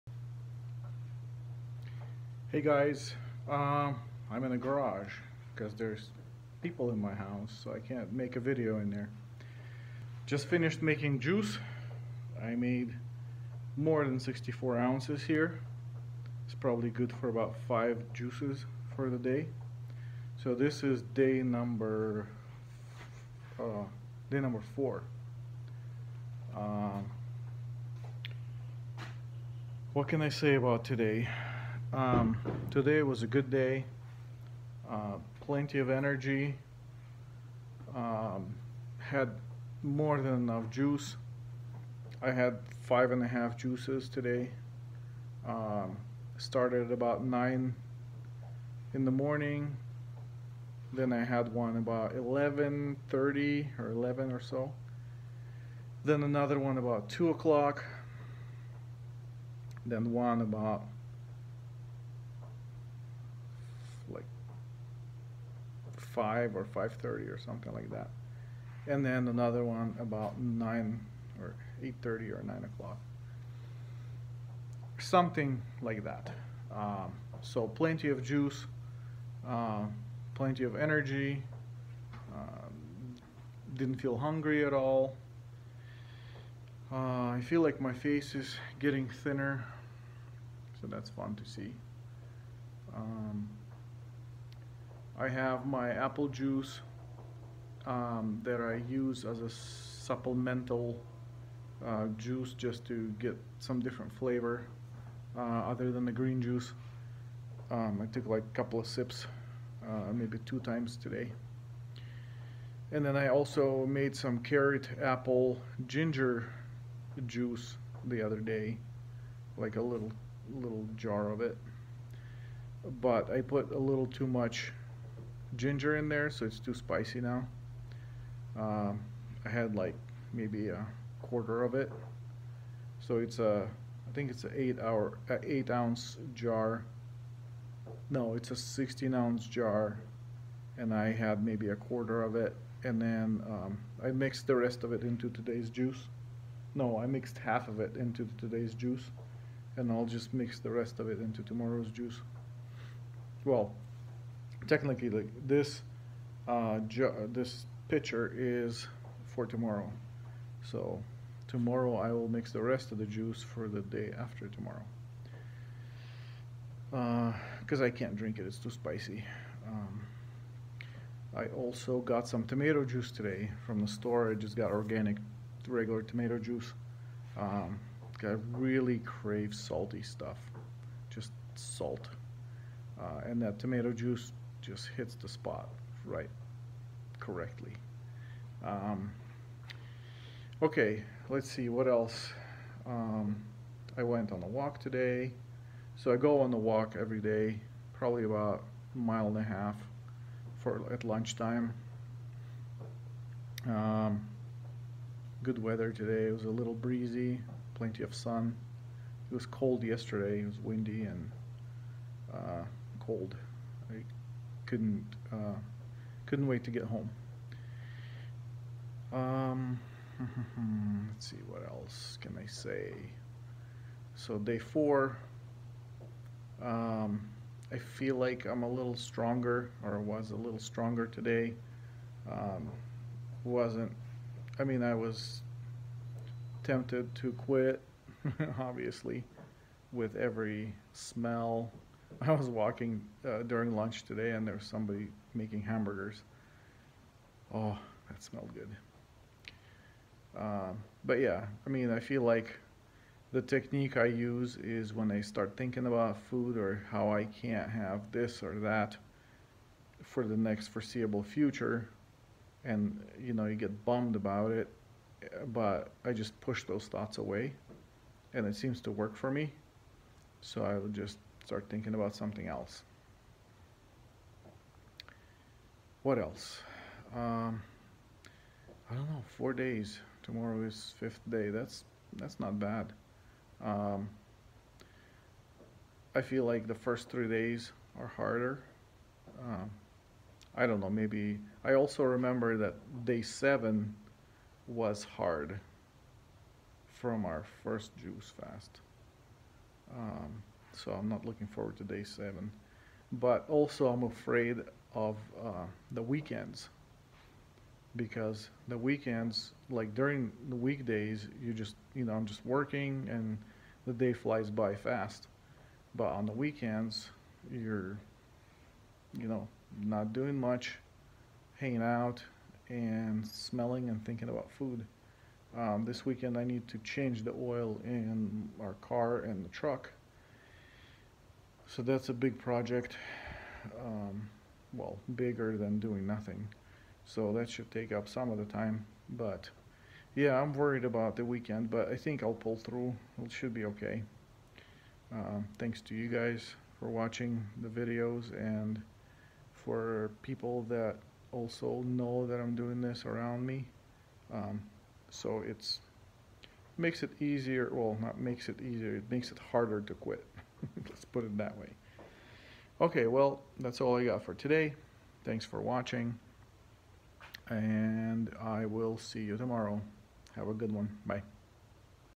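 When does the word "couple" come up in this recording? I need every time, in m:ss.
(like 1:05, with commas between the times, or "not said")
1:48.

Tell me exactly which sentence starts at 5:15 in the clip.
But on the weekends, you're, you know, not doing much, hanging out and smelling and thinking about food.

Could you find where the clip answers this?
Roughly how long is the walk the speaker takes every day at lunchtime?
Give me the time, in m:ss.
3:18.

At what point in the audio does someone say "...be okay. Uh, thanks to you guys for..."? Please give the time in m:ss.
5:43.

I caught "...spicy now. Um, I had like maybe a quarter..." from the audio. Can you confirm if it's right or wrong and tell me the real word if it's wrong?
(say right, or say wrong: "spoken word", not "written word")
right.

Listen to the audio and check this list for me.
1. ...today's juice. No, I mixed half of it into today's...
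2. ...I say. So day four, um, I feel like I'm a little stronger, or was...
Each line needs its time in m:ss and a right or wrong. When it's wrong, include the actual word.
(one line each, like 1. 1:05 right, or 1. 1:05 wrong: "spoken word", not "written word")
1. 2:25 right
2. 3:42 right.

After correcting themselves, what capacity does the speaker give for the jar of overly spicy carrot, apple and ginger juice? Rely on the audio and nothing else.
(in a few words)
16 ounces.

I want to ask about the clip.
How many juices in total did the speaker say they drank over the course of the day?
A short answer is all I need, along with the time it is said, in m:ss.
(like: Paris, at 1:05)
5 and a half, at 0:42.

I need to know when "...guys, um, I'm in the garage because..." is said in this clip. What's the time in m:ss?
0:02.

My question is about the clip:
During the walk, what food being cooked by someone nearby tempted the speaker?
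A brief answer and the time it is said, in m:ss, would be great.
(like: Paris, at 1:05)
Hamburgers, at 4:05.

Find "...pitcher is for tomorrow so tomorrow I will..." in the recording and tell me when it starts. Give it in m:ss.
2:37.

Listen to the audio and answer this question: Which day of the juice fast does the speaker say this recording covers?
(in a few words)
4.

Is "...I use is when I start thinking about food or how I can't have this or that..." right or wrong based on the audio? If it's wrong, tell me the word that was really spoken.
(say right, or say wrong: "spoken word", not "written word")
right.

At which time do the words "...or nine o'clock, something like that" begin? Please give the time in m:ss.
1:12.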